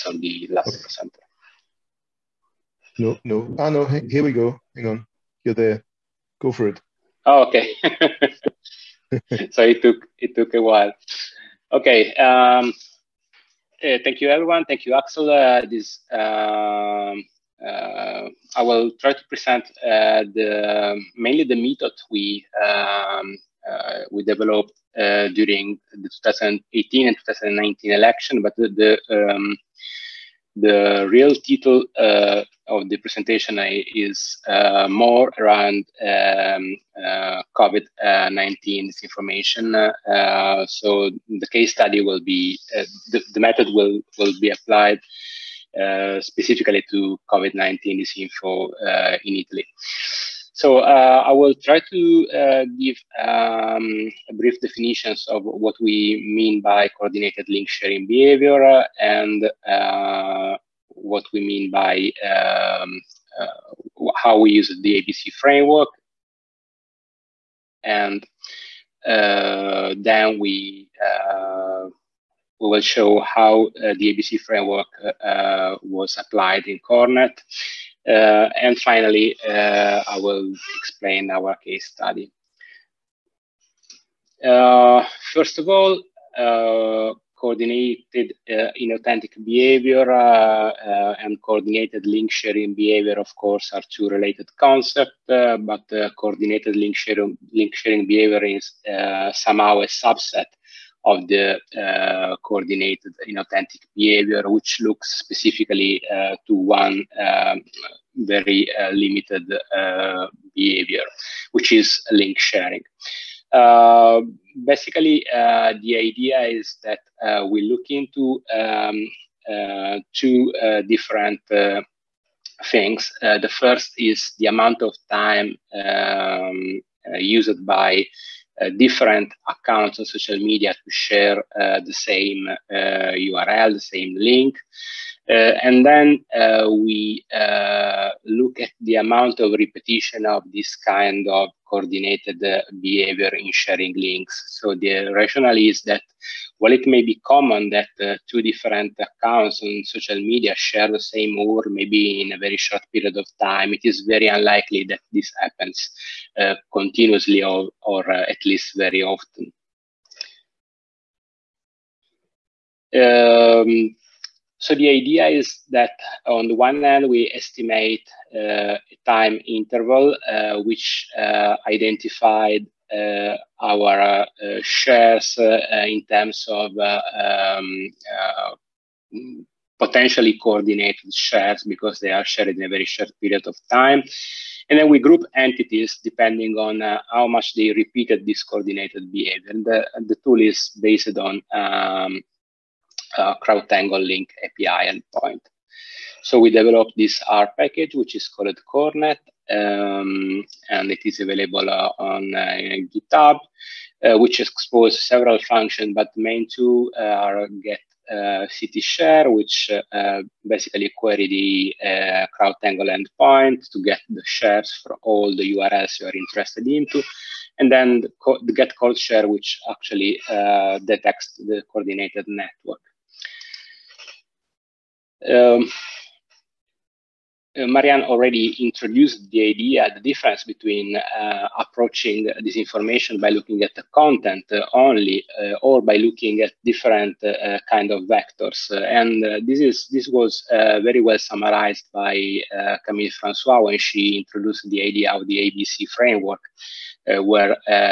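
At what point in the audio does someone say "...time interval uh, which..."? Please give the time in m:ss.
2:49.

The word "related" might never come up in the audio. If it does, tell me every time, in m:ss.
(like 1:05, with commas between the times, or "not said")
1:34.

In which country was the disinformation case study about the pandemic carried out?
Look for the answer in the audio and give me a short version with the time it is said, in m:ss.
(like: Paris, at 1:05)
Italy, at 0:49.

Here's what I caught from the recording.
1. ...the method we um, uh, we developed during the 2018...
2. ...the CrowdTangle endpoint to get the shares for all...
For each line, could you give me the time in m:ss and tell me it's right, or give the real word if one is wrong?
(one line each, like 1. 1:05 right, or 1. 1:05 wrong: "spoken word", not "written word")
1. 0:21 right
2. 3:31 right.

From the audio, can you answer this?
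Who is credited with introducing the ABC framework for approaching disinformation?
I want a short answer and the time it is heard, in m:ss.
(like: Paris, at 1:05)
Camille Francois, at 4:02.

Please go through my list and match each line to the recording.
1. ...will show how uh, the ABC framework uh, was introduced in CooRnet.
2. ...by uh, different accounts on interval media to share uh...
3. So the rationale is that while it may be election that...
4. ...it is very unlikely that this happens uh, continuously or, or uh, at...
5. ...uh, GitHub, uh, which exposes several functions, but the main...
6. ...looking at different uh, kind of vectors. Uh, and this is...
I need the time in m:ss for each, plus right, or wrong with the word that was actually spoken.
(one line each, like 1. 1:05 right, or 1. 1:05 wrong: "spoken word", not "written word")
1. 1:12 wrong: "applied", not "introduced"
2. 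2:07 wrong: "social", not "interval"
3. 2:24 wrong: "common", not "election"
4. 2:33 right
5. 3:22 right
6. 3:55 right.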